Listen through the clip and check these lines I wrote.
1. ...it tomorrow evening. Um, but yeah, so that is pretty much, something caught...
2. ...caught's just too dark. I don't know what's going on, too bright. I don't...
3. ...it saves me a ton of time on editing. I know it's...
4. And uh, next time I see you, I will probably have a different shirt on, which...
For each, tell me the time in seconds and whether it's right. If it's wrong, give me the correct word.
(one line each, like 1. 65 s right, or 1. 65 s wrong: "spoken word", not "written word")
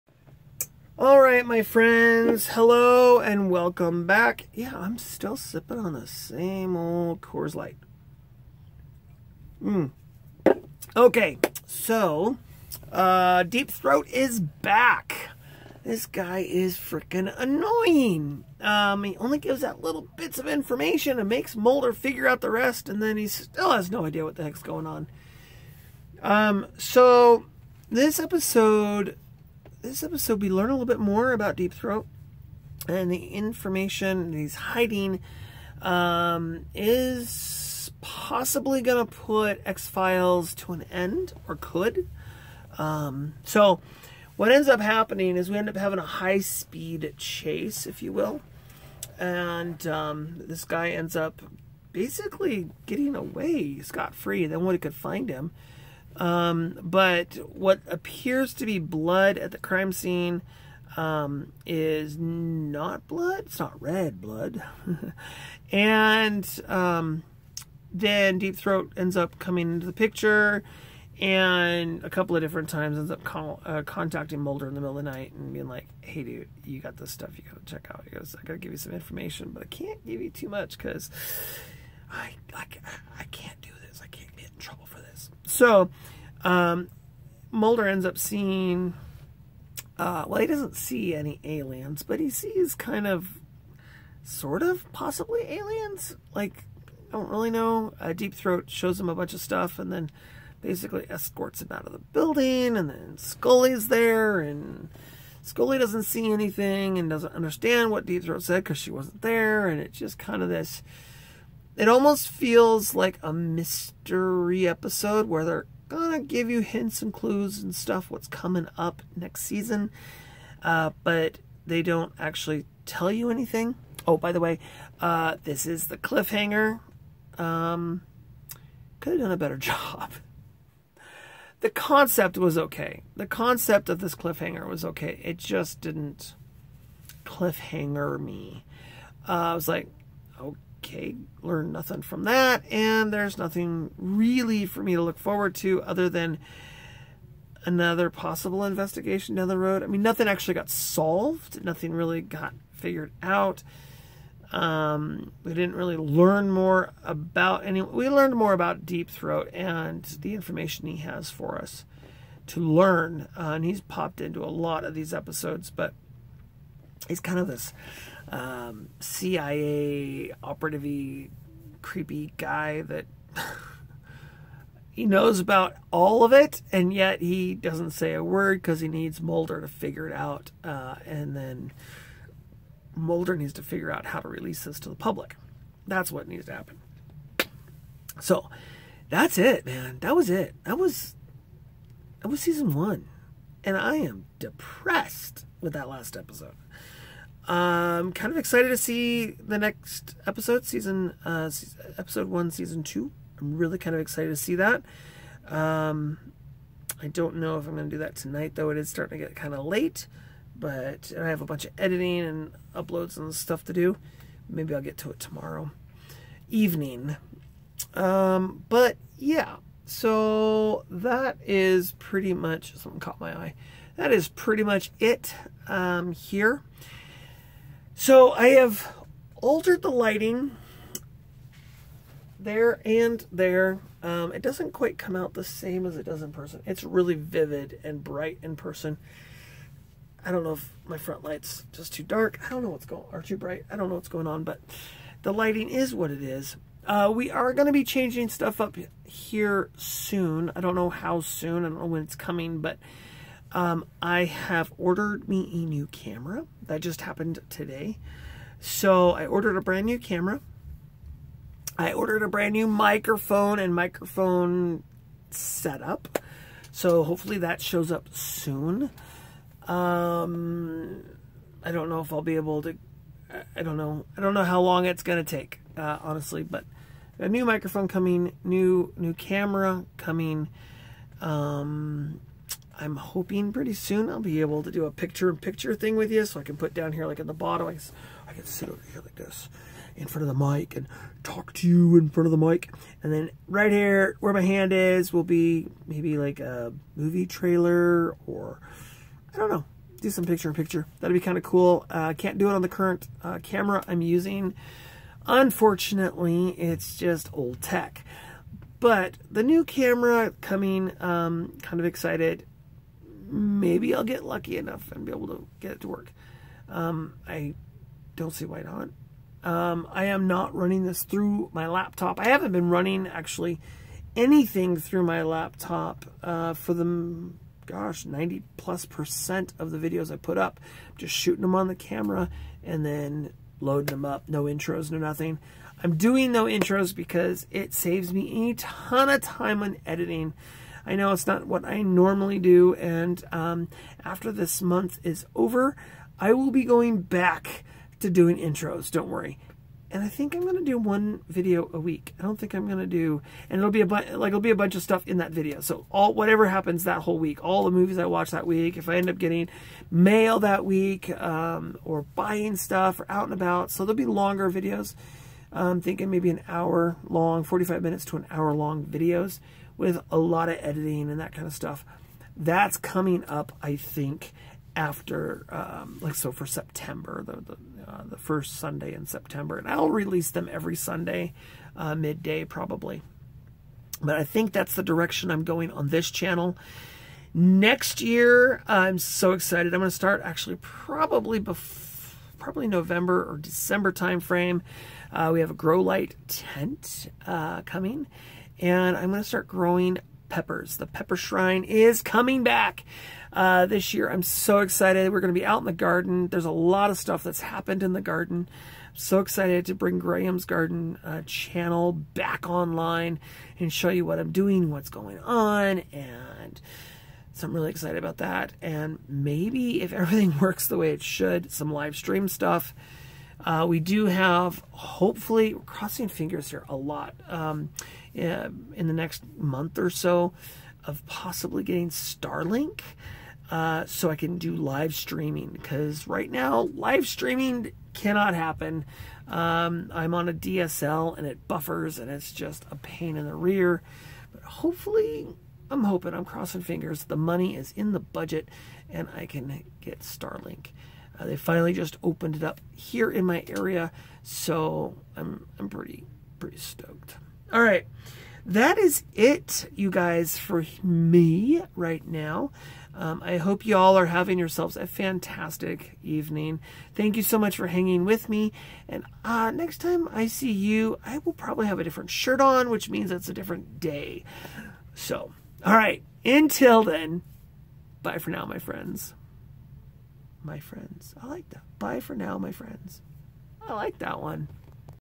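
1. 215 s right
2. 241 s wrong: "light", not "caught"
3. 337 s right
4. 468 s right.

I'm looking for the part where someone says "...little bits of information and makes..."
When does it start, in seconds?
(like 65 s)
19 s.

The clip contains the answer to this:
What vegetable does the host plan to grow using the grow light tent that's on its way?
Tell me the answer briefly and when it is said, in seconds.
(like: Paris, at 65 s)
peppers, at 400 s.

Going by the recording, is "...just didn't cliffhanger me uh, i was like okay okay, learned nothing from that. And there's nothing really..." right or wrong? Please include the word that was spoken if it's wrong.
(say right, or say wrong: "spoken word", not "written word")
right.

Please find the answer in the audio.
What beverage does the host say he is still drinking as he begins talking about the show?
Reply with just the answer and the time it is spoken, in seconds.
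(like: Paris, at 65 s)
Coors Light, at 7 s.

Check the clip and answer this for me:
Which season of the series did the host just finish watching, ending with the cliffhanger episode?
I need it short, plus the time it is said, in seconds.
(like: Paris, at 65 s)
season one, at 192 s.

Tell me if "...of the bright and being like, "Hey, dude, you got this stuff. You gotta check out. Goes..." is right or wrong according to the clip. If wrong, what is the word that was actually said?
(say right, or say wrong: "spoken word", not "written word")
wrong: "night", not "bright".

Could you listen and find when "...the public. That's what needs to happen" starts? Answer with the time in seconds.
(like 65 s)
184 s.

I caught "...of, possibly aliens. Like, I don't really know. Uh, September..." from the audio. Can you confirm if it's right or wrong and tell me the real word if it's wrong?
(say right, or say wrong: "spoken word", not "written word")
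wrong: "Deep", not "September".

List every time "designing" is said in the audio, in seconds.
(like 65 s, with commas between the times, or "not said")
not said.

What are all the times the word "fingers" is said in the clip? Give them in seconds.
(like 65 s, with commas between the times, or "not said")
426 s, 446 s.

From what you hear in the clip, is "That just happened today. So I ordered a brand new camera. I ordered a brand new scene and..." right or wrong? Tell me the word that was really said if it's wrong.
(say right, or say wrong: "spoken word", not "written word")
wrong: "microphone", not "scene".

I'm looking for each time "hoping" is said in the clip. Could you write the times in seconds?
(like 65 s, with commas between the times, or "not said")
282 s, 445 s.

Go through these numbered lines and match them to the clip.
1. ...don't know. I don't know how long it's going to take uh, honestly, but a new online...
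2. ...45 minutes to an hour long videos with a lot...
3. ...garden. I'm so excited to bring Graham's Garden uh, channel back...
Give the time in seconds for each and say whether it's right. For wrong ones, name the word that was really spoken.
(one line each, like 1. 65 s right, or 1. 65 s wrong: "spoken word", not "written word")
1. 273 s wrong: "microphone", not "online"
2. 367 s right
3. 408 s right.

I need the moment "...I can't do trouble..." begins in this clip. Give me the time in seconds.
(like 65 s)
83 s.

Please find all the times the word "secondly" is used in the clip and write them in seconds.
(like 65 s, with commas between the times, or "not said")
not said.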